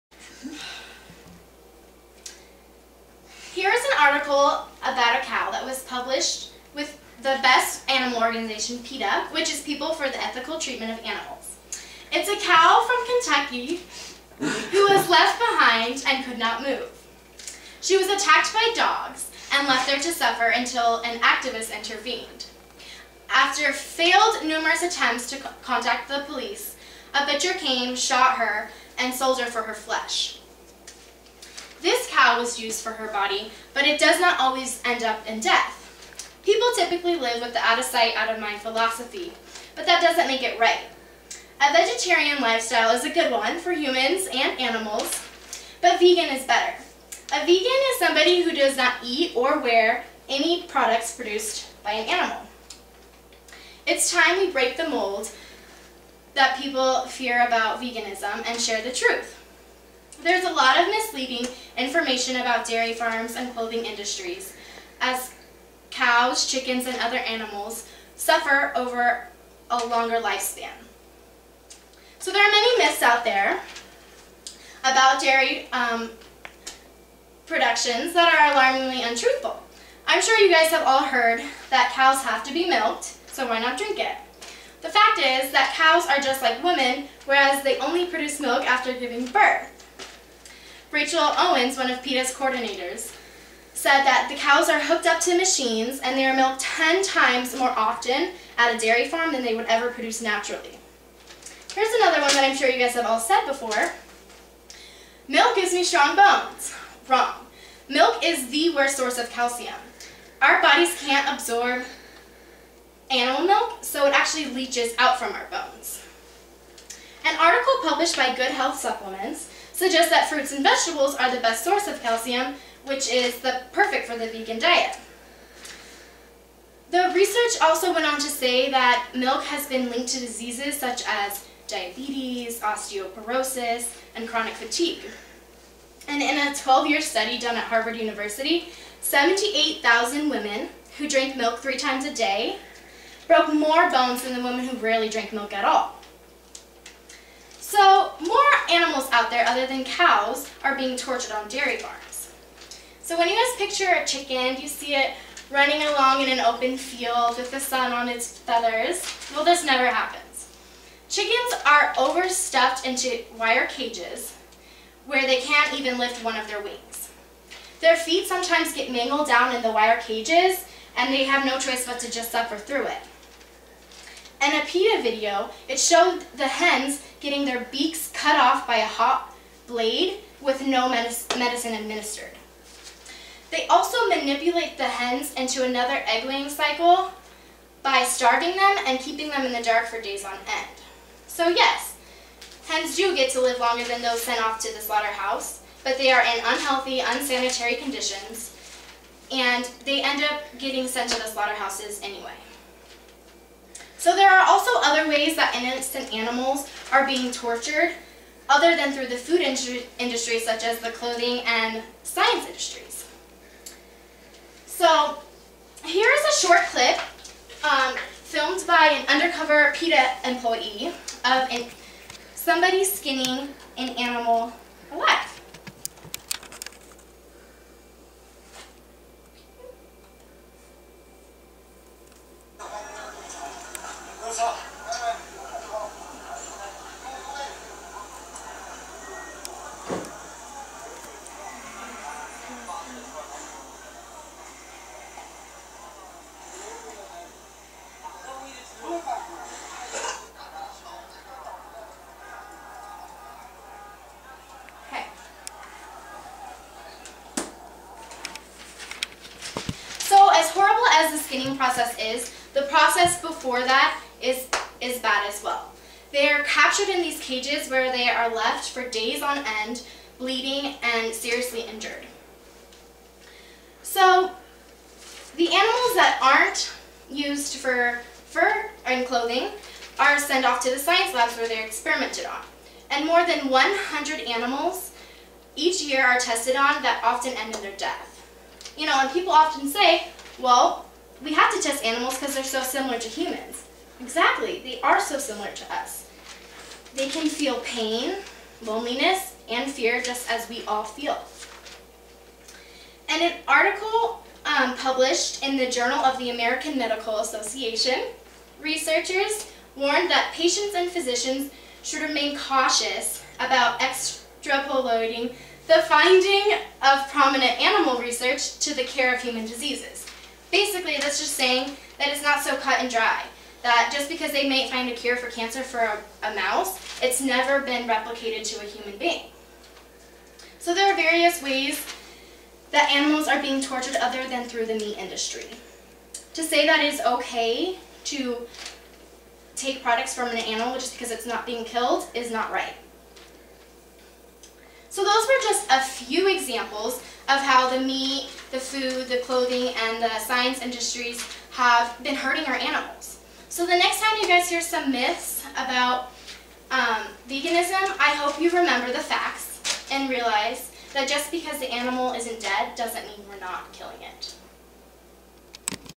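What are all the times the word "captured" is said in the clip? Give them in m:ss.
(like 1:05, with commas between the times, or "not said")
4:26.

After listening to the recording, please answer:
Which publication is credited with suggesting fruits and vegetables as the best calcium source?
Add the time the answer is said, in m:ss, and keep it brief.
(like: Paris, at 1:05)
Good Health Supplements, at 1:58.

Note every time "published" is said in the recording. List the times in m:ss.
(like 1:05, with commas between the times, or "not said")
0:05, 1:57, 5:04.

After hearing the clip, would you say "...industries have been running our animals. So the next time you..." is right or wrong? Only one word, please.
wrong.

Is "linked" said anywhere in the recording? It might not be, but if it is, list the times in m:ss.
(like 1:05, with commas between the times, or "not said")
2:09.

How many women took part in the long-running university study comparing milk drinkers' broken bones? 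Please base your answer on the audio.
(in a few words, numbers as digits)
78,000.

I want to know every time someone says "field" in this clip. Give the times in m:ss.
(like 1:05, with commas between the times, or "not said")
2:36.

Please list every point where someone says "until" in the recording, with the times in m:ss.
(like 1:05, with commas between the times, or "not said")
0:20.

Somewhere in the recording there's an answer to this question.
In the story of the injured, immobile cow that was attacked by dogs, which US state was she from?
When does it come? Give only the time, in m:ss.
0:13.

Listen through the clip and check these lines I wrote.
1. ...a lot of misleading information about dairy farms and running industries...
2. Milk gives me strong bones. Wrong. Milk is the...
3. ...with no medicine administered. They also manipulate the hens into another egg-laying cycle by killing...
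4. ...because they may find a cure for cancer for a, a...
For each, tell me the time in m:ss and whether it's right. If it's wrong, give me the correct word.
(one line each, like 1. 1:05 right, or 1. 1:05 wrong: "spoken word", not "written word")
1. 1:00 wrong: "clothing", not "running"
2. 1:45 right
3. 3:00 wrong: "starving", not "killing"
4. 5:24 right.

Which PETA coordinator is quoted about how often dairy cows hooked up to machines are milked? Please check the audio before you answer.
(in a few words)
Rachel Owens.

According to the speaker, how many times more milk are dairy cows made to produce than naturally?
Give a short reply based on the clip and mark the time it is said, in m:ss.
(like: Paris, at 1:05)
10, at 1:36.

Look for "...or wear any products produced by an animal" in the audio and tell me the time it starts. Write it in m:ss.
0:49.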